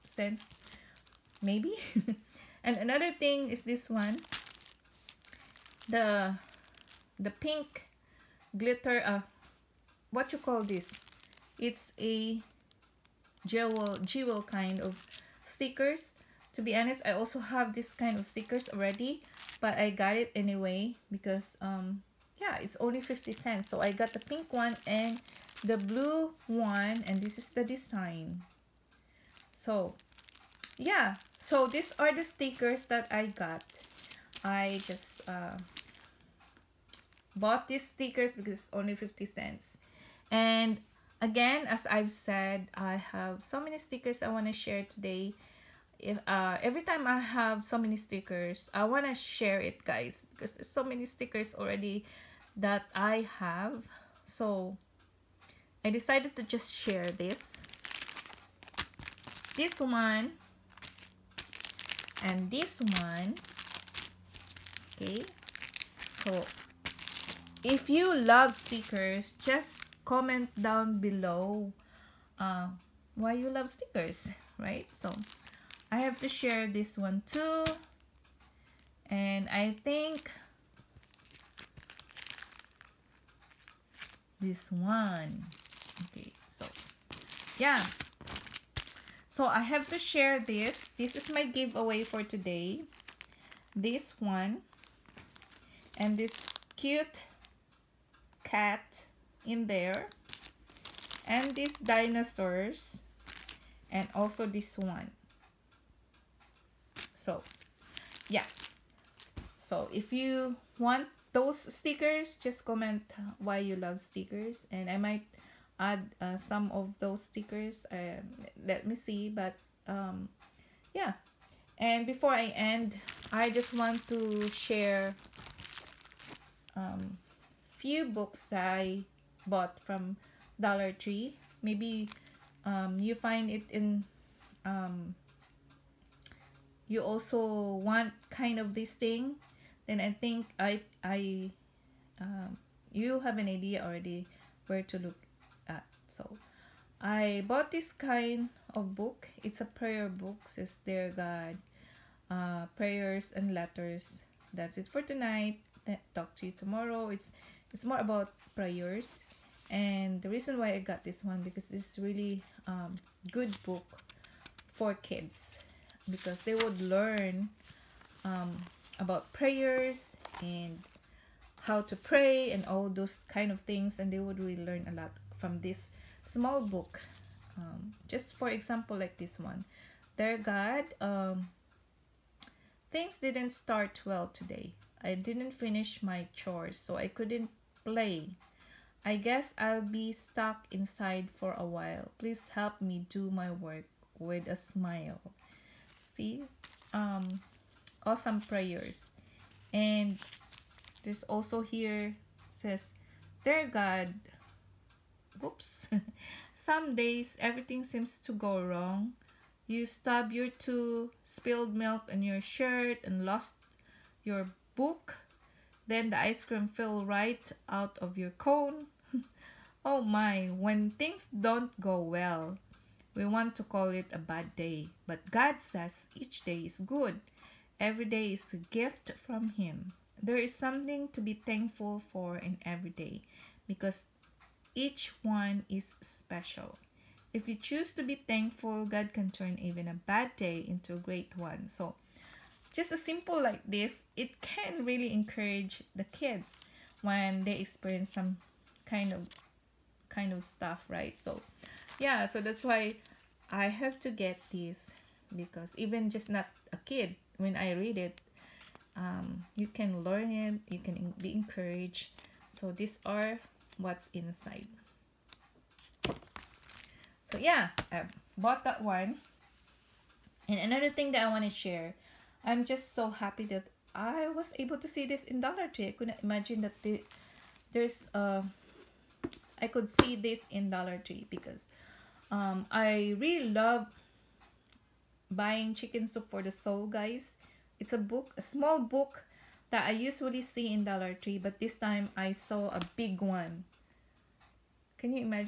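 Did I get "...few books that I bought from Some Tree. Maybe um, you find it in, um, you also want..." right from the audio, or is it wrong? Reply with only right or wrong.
wrong.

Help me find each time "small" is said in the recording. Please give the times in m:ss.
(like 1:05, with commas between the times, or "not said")
2:56, 4:48.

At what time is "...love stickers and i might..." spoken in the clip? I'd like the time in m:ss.
1:53.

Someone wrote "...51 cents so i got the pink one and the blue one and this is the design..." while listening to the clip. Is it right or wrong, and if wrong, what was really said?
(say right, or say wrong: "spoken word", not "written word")
wrong: "50", not "51".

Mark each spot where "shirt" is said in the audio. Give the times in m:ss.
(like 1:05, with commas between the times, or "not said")
3:32.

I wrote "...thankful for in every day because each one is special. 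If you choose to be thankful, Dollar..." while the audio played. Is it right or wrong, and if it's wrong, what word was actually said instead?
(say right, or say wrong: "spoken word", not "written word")
wrong: "God", not "Dollar".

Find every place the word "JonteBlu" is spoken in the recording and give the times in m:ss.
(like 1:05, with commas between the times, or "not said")
not said.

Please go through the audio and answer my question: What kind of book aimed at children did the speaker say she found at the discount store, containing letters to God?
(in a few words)
prayer book.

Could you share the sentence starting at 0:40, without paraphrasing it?
And again, as I've said, I have so many stickers I want to share today.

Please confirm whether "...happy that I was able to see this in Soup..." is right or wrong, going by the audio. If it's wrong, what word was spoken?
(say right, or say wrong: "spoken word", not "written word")
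wrong: "Dollar", not "Soup".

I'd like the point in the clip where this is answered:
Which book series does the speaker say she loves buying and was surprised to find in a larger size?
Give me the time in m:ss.
4:45.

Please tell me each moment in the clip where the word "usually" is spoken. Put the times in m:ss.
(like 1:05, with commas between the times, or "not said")
4:49.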